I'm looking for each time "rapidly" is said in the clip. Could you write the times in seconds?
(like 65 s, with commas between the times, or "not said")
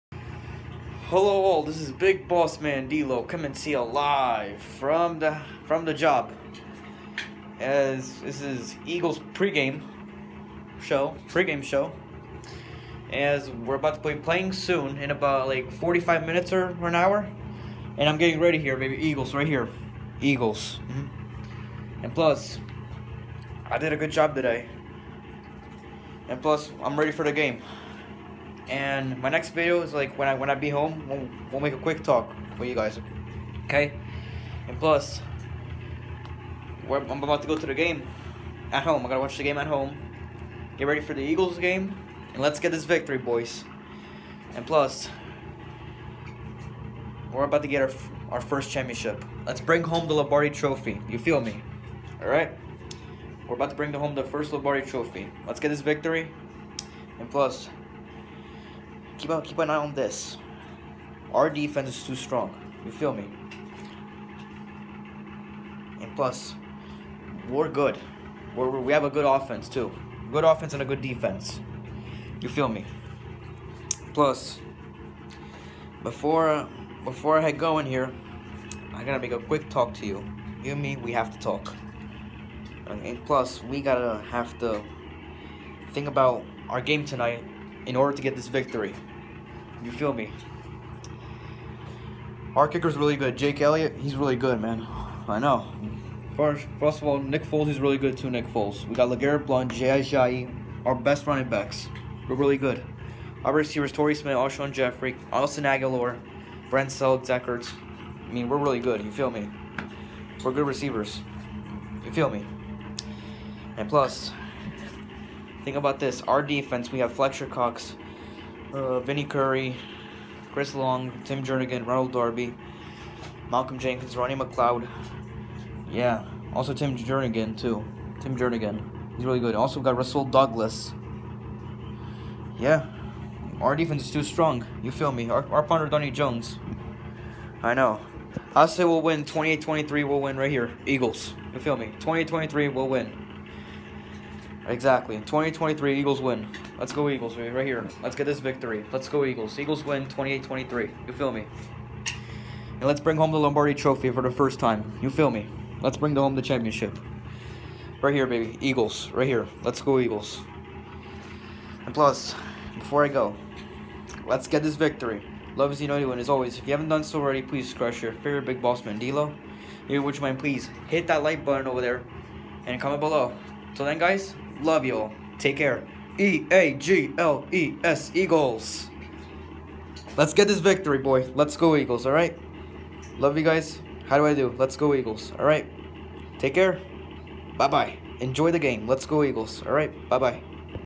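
not said.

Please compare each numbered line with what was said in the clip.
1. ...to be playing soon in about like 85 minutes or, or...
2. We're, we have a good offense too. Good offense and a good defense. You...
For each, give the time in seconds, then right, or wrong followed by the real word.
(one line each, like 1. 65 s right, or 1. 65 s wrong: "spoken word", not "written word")
1. 14 s wrong: "45", not "85"
2. 68 s right.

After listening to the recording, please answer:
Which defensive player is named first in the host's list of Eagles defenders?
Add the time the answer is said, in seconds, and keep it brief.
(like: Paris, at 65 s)
Fletcher Cox, at 117 s.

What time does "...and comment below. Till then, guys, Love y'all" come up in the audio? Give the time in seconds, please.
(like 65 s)
172 s.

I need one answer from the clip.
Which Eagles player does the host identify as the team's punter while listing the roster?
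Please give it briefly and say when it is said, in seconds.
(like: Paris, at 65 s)
Donnie Jones, at 135 s.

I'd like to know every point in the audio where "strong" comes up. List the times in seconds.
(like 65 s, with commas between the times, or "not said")
62 s, 134 s.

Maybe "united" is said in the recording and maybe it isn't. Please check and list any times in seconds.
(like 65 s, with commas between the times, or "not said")
165 s.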